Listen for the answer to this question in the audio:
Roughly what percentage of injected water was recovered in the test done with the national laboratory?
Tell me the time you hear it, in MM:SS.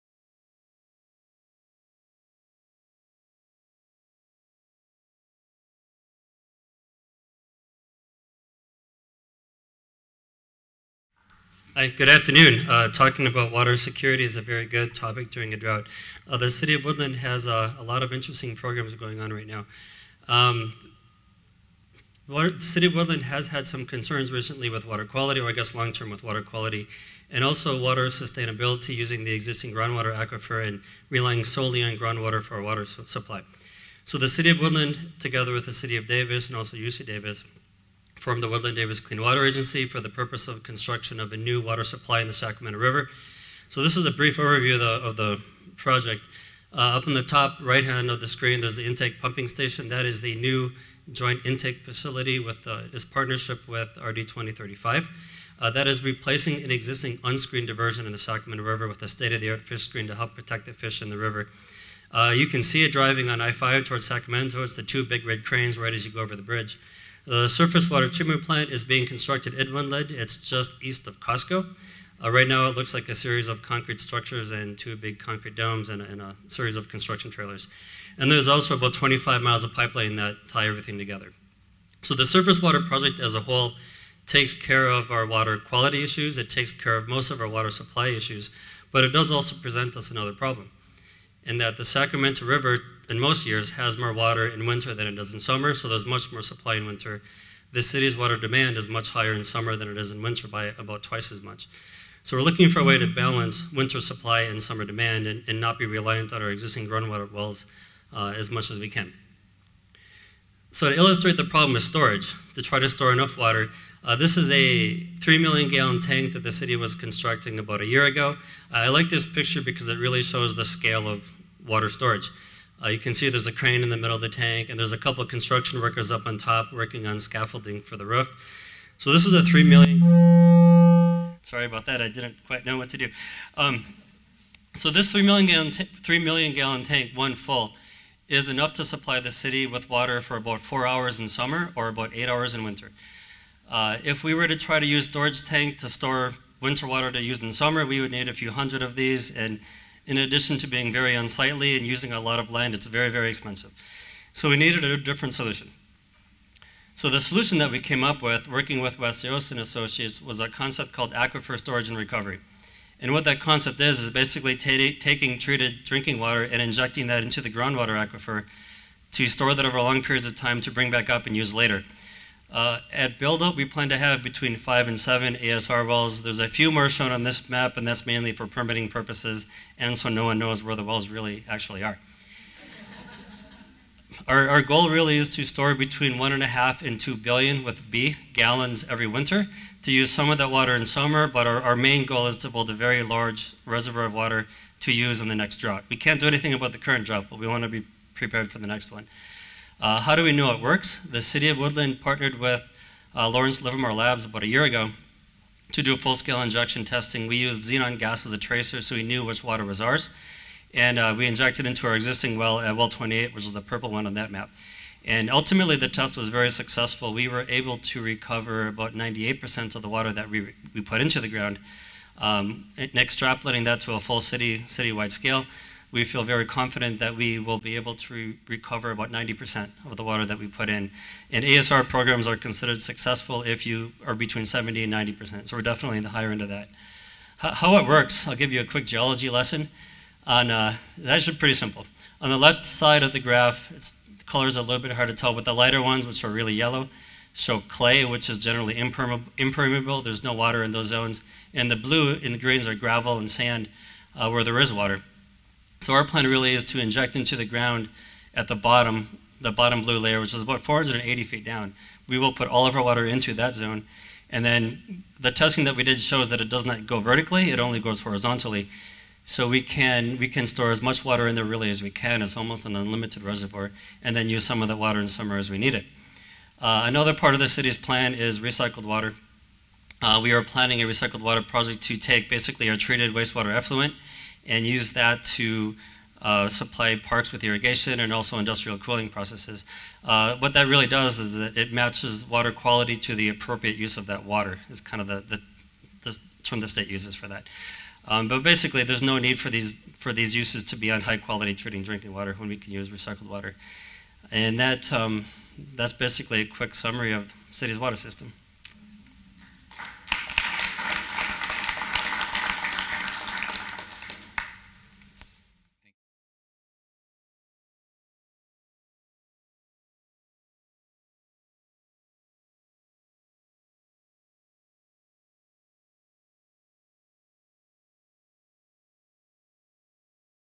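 03:38.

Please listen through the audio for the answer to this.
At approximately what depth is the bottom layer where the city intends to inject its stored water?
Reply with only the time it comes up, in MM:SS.
04:20.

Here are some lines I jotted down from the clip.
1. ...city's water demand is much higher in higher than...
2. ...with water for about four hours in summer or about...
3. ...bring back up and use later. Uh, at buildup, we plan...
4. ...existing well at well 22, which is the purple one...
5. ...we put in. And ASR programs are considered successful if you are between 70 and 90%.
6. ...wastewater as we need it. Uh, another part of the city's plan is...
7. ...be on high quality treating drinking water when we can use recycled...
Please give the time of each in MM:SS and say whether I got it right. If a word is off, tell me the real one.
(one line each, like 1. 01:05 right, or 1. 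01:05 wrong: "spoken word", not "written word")
1. 01:37 wrong: "summer", not "higher"
2. 02:19 right
3. 02:50 right
4. 03:31 wrong: "28", not "22"
5. 03:50 right
6. 04:35 wrong: "summer", not "wastewater"
7. 05:00 right.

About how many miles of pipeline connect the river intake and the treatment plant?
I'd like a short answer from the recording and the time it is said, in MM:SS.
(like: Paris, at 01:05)
25 miles, at 01:18.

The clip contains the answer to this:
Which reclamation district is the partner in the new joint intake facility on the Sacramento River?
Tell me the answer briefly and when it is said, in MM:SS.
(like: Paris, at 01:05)
RD 2035, at 00:53.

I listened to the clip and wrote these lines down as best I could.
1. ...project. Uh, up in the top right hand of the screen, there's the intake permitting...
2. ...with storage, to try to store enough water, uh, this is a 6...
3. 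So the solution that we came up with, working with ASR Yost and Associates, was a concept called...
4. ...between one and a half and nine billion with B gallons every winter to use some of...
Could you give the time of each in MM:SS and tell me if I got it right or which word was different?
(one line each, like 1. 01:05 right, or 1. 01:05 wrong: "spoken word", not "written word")
1. 00:45 wrong: "pumping", not "permitting"
2. 01:51 wrong: "3", not "6"
3. 02:36 wrong: "West", not "ASR"
4. 03:05 wrong: "two", not "nine".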